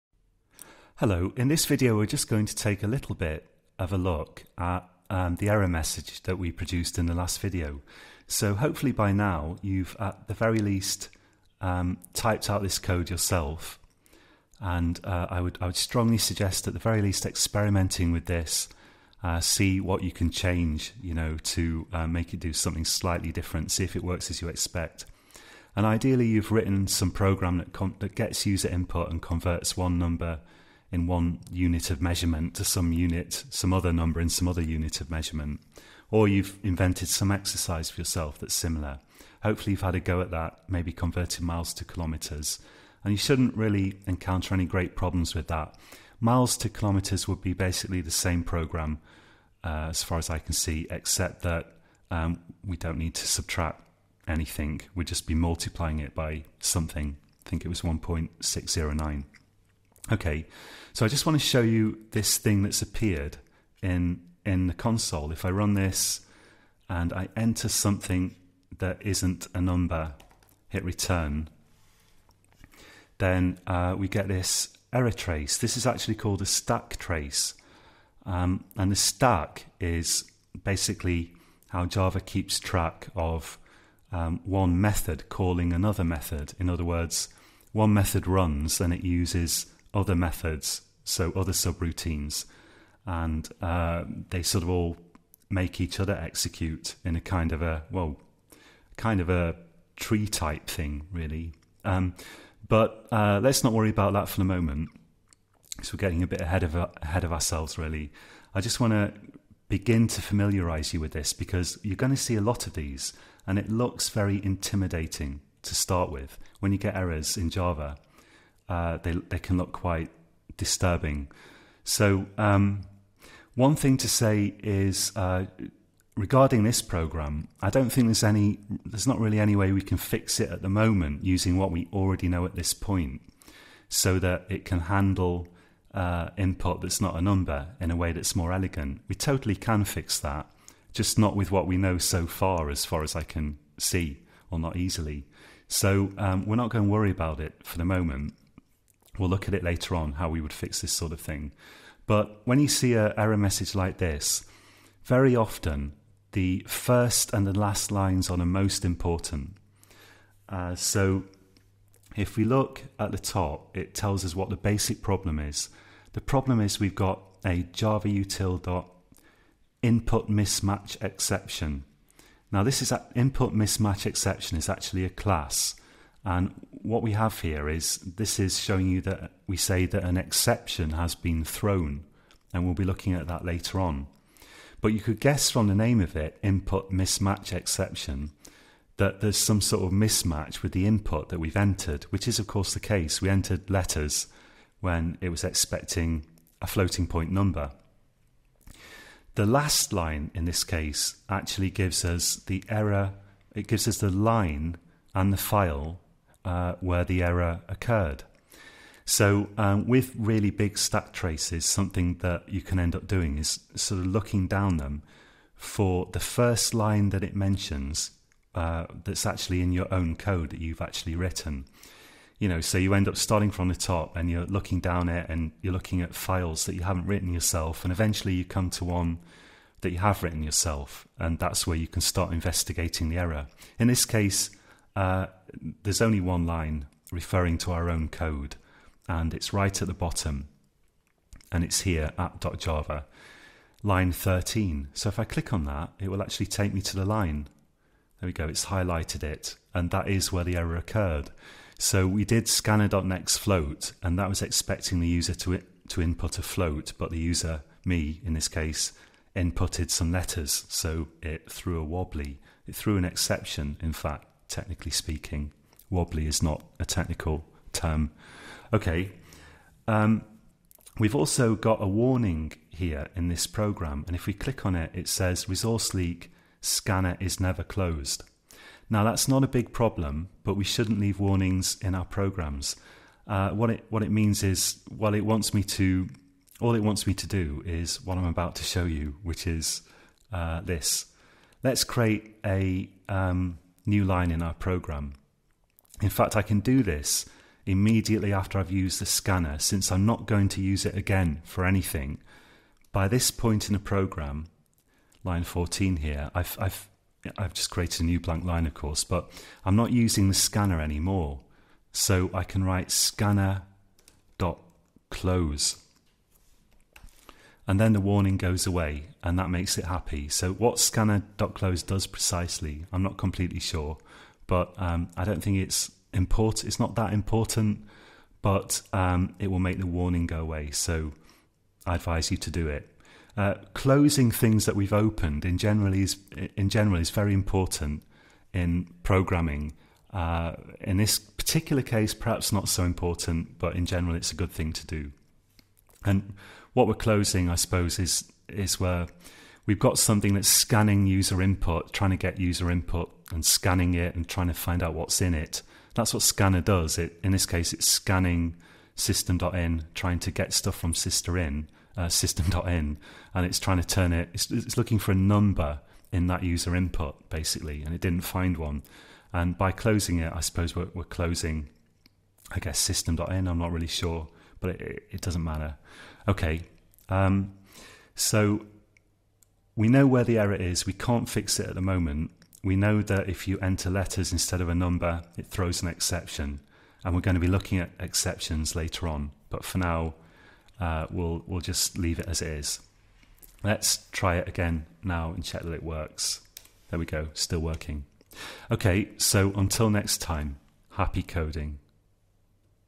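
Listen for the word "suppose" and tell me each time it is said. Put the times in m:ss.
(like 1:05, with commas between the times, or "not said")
5:47, 6:10.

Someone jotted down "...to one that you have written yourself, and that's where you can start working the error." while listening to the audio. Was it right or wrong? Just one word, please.
wrong.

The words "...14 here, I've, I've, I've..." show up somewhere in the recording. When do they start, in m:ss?
5:05.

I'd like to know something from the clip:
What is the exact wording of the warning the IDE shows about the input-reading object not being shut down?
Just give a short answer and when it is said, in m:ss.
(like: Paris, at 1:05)
Resource Leak Scanner is never closed, at 4:35.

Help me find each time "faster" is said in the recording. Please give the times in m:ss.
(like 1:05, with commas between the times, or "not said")
not said.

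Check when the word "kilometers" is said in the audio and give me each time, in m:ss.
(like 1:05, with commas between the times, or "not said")
0:41, 0:46.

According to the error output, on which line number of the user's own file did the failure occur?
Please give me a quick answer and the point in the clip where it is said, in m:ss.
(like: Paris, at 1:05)
13, at 4:03.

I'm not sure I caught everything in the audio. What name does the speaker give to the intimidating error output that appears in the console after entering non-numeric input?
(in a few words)
stack trace.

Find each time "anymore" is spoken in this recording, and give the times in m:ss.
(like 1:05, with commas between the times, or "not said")
5:10.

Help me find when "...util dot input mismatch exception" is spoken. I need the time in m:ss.
2:48.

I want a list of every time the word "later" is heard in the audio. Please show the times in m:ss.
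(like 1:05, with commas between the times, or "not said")
2:29, 3:03, 6:28.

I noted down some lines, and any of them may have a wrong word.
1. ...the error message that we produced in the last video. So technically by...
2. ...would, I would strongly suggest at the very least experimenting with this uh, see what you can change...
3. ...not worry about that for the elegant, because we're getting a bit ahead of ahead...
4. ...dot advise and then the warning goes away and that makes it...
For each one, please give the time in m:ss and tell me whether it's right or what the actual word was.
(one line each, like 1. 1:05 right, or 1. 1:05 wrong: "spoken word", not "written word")
1. 0:05 wrong: "hopefully", not "technically"
2. 0:15 right
3. 1:43 wrong: "moment", not "elegant"
4. 5:14 wrong: "close", not "advise".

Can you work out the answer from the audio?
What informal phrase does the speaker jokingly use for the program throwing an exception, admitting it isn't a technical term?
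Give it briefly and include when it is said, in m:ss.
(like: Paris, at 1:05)
threw a wobbly, at 4:21.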